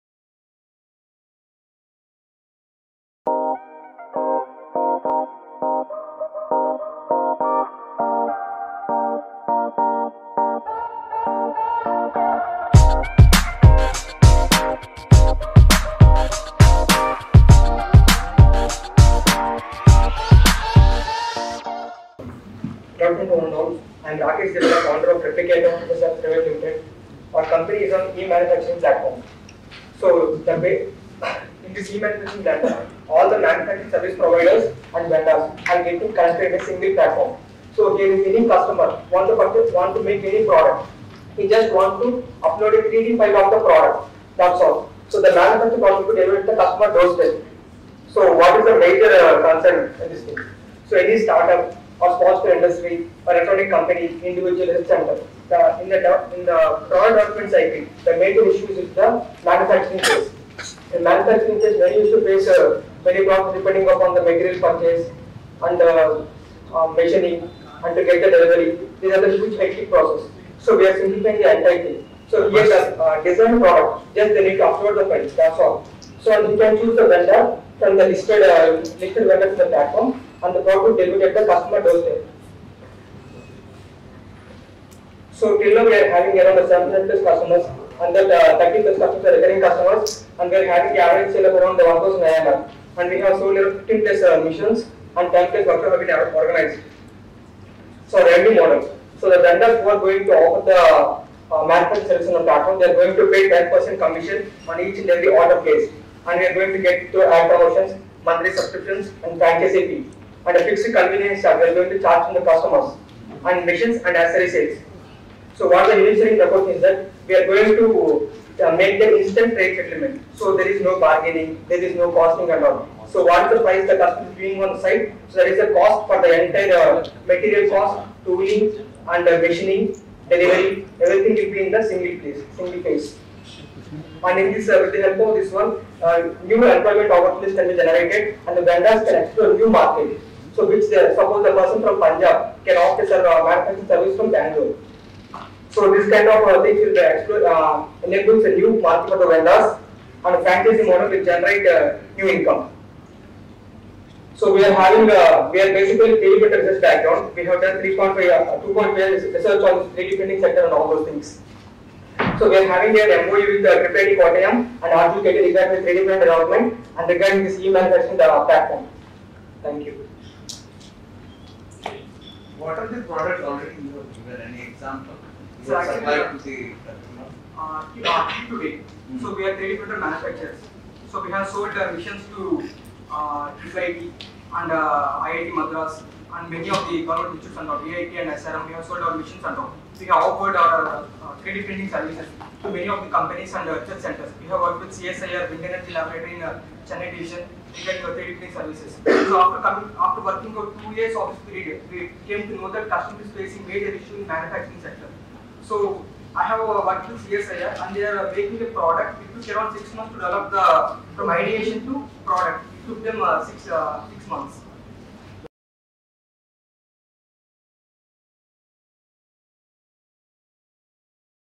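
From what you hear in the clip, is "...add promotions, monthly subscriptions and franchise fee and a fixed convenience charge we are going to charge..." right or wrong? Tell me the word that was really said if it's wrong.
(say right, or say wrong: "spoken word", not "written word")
right.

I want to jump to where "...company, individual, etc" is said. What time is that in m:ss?
0:53.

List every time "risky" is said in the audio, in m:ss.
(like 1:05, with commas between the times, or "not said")
not said.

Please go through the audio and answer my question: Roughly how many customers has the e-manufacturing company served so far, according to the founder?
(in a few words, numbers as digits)
700+.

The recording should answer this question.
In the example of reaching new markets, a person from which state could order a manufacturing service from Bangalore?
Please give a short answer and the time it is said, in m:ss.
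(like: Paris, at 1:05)
Punjab, at 2:21.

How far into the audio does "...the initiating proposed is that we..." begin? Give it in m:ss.
1:55.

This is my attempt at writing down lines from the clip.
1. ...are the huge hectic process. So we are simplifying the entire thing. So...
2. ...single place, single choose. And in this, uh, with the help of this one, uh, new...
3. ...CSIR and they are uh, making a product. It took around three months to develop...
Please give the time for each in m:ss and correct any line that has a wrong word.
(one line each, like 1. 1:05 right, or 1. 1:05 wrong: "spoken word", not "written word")
1. 1:09 right
2. 2:11 wrong: "phase", not "choose"
3. 3:27 wrong: "six", not "three".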